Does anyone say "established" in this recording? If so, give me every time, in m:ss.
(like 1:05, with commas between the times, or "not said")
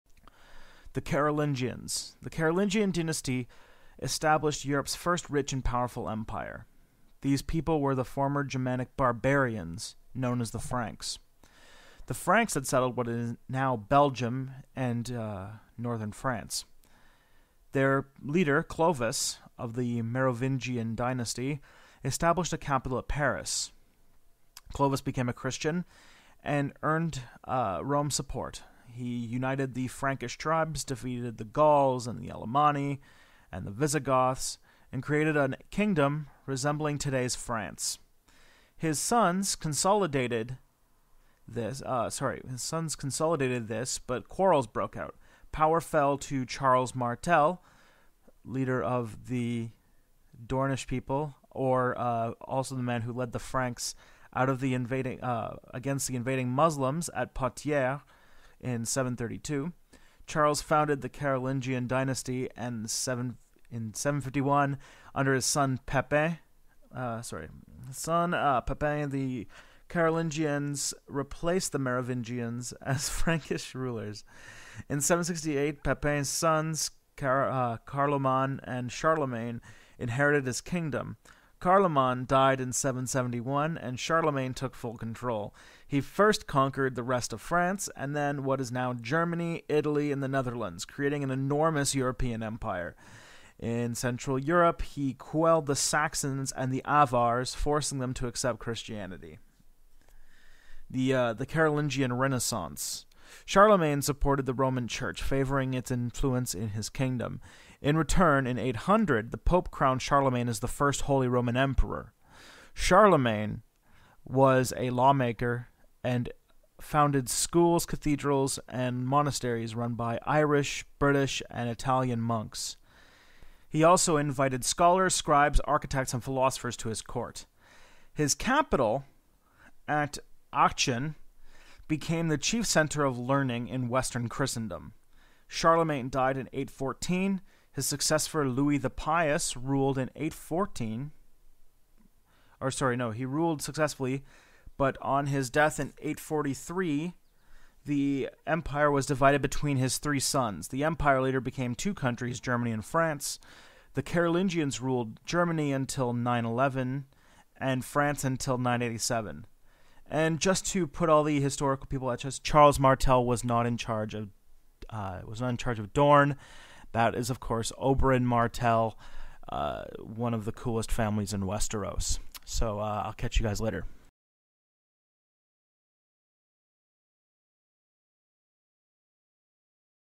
0:04, 0:22.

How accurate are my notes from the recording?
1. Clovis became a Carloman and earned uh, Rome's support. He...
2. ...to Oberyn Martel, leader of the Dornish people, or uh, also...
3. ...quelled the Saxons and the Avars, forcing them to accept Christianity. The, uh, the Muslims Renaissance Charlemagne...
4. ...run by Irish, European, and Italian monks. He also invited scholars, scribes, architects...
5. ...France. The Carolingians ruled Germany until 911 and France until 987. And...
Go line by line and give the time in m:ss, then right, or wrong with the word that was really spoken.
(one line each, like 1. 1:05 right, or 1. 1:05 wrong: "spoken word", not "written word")
1. 0:24 wrong: "Christian", not "Carloman"
2. 0:46 wrong: "Charles", not "Oberyn"
3. 1:35 wrong: "Carolingian", not "Muslims"
4. 1:59 wrong: "British", not "European"
5. 2:32 right.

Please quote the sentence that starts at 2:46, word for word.
That is, of course, Oberyn Martell, uh, one of the coolest families in Westeros.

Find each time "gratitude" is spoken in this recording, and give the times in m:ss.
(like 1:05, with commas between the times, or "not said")
not said.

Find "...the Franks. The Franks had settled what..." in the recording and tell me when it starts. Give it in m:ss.
0:10.